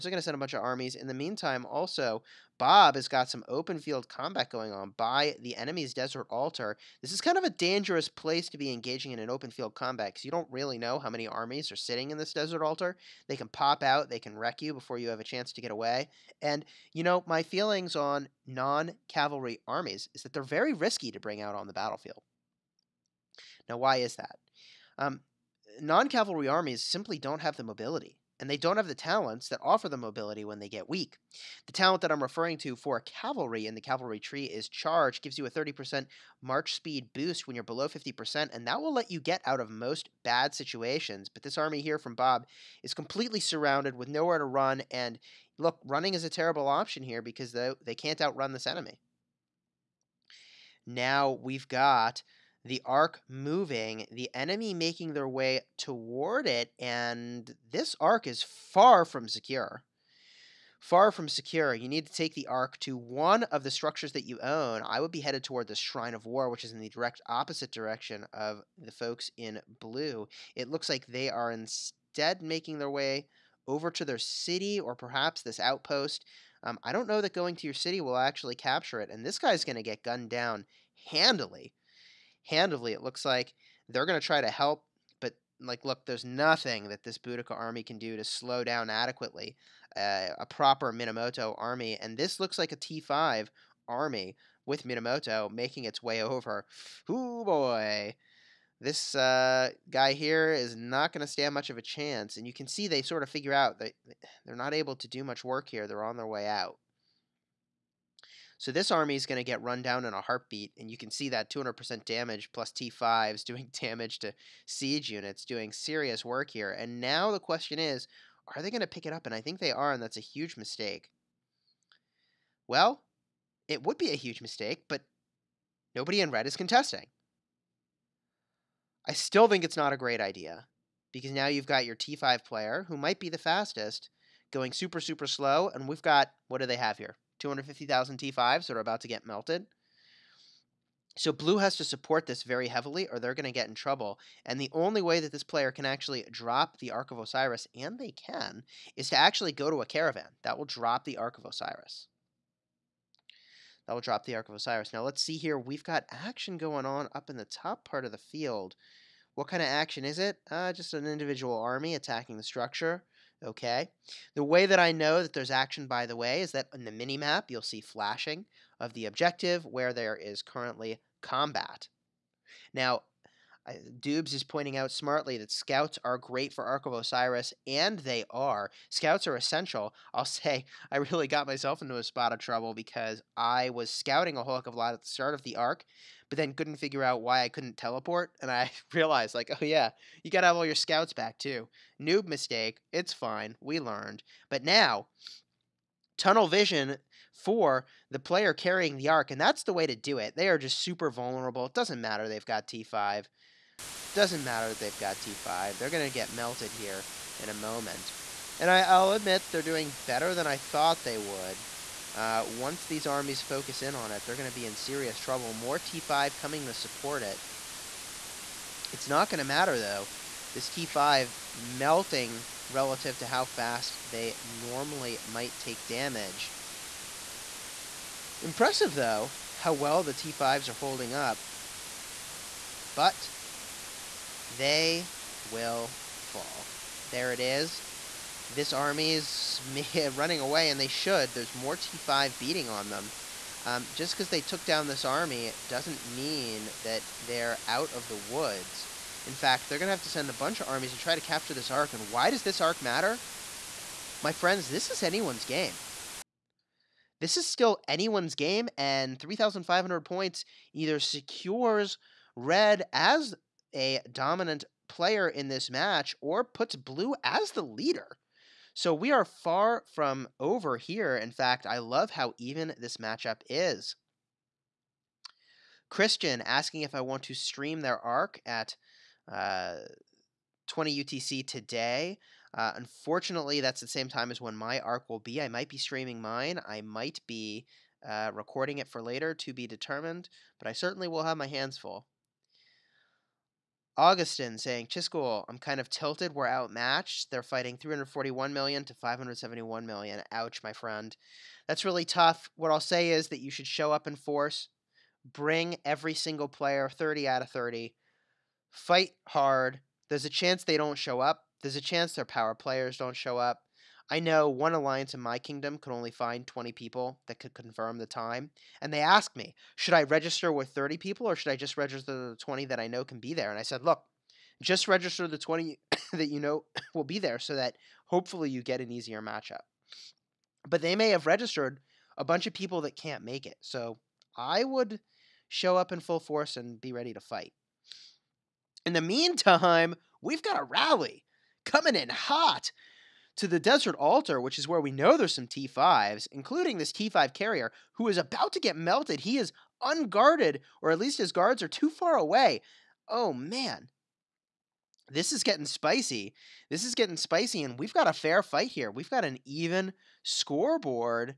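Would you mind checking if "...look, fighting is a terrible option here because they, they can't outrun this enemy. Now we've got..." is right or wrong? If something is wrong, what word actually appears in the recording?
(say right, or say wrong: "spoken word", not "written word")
wrong: "running", not "fighting".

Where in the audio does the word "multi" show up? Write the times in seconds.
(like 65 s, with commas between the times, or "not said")
not said.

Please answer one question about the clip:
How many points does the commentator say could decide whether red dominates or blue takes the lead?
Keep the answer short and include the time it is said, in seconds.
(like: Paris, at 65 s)
3,500, at 259 s.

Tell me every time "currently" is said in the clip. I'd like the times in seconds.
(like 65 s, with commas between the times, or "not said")
170 s.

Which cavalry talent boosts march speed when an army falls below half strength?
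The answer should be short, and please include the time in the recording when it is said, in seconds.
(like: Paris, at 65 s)
Charge, at 34 s.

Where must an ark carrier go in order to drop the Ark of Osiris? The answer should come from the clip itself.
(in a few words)
A caravan.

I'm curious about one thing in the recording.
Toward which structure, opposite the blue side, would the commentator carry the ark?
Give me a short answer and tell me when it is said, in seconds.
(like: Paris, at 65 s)
Shrine of War, at 65 s.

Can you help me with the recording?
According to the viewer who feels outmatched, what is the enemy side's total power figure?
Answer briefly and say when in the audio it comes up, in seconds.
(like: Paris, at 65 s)
571 million, at 298 s.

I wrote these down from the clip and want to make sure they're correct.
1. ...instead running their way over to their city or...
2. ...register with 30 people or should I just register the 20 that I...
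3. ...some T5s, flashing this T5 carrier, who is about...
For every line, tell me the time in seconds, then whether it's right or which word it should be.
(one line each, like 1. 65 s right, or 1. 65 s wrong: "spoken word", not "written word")
1. 71 s wrong: "making", not "running"
2. 320 s right
3. 345 s wrong: "including", not "flashing".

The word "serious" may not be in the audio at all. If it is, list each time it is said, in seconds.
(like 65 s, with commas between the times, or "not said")
115 s, 214 s.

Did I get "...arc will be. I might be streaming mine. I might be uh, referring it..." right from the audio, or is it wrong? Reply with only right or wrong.
wrong.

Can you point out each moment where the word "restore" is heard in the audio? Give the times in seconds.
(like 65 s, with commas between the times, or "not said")
not said.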